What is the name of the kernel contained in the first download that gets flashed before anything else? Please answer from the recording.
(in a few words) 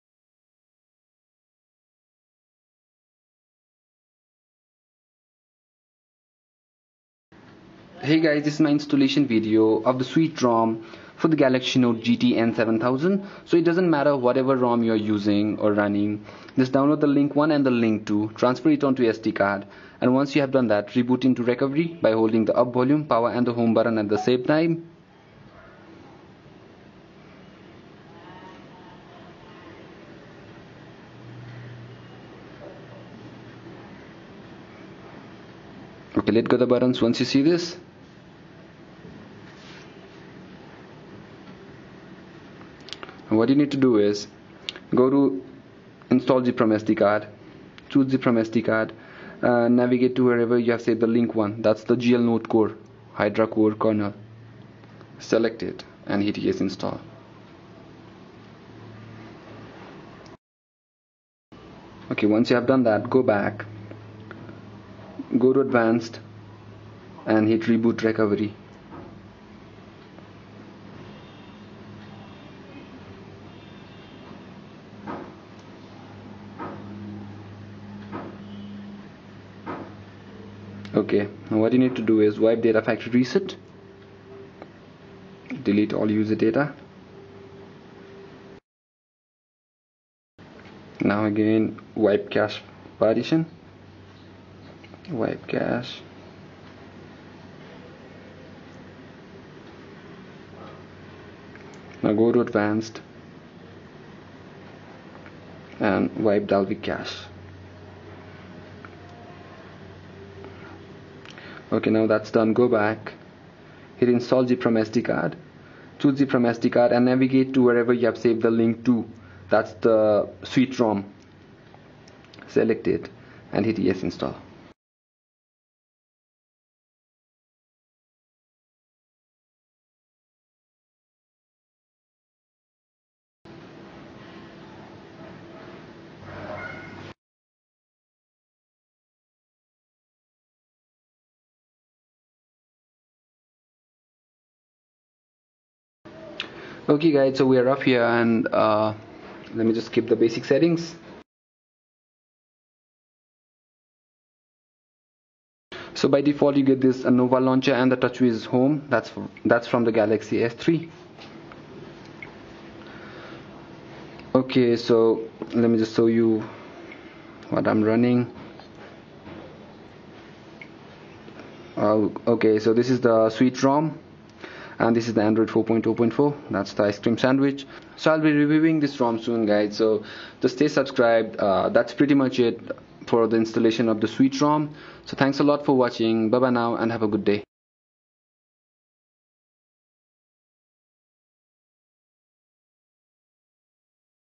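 Hydra Core.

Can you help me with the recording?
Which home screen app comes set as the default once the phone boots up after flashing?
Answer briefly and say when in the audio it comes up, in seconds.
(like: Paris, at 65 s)
Nova launcher, at 157 s.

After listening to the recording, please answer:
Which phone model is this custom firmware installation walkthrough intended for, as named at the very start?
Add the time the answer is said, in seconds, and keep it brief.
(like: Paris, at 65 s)
Galaxy Note GT N7000, at 11 s.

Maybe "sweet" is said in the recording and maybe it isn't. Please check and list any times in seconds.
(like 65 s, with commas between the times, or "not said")
10 s, 120 s, 173 s, 184 s.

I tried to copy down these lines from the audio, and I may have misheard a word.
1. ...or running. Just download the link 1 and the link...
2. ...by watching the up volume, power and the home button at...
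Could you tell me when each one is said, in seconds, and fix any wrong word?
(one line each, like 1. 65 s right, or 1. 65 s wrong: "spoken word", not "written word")
1. 15 s right
2. 22 s wrong: "holding", not "watching".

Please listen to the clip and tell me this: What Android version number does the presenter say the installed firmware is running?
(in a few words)
4.0.4.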